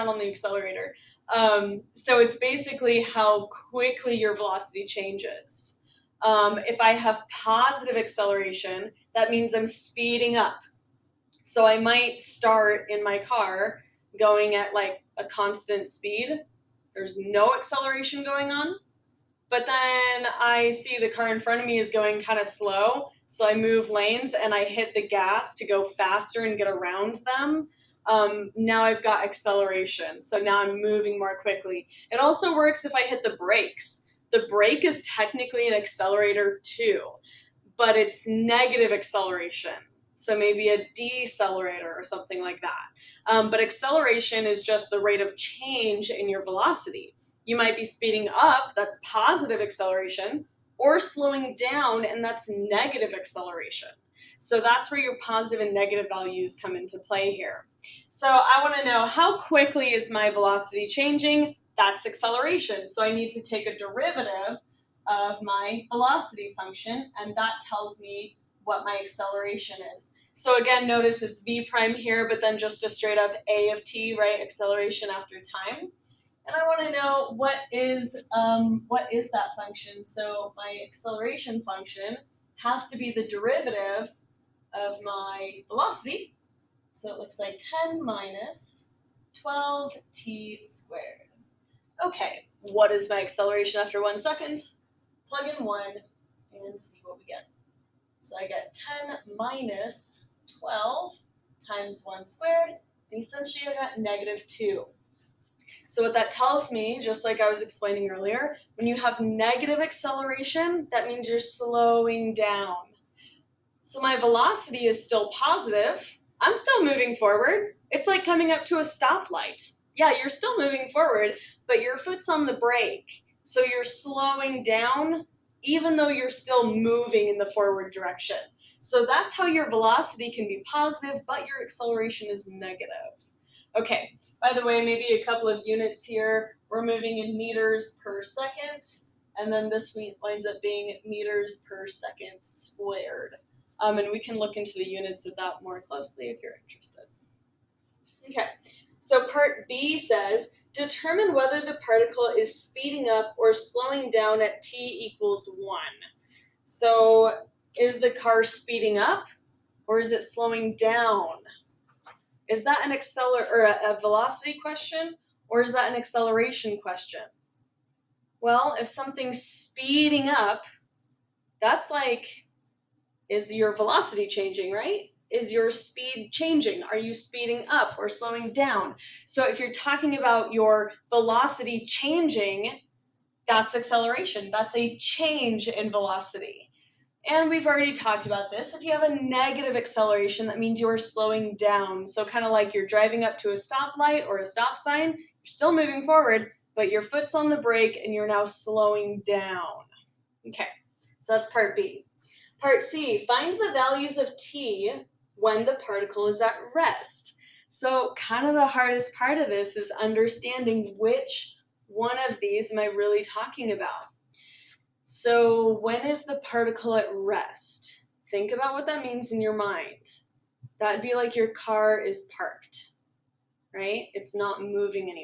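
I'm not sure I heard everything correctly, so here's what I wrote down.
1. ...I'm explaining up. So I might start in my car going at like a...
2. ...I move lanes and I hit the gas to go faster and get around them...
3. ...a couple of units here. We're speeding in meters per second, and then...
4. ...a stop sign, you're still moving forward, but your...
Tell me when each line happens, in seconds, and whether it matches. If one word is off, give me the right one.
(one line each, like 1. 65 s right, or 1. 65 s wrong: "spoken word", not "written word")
1. 9 s wrong: "speeding", not "explaining"
2. 23 s right
3. 135 s wrong: "moving", not "speeding"
4. 194 s right.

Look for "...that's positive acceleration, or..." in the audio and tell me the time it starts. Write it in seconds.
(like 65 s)
48 s.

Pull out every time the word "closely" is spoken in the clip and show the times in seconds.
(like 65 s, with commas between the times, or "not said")
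145 s.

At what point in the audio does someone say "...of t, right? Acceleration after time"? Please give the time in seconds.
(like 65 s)
73 s.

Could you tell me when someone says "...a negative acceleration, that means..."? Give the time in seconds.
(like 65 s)
189 s.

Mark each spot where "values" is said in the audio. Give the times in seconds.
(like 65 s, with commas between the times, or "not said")
56 s, 203 s.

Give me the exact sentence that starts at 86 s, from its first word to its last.
So it looks like 10 minus 12t squared.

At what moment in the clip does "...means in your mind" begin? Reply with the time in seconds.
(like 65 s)
219 s.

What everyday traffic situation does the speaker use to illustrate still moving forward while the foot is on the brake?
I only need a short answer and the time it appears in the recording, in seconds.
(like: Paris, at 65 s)
Coming up to a stoplight, at 118 s.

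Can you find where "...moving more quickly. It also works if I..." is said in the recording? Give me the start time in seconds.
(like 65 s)
30 s.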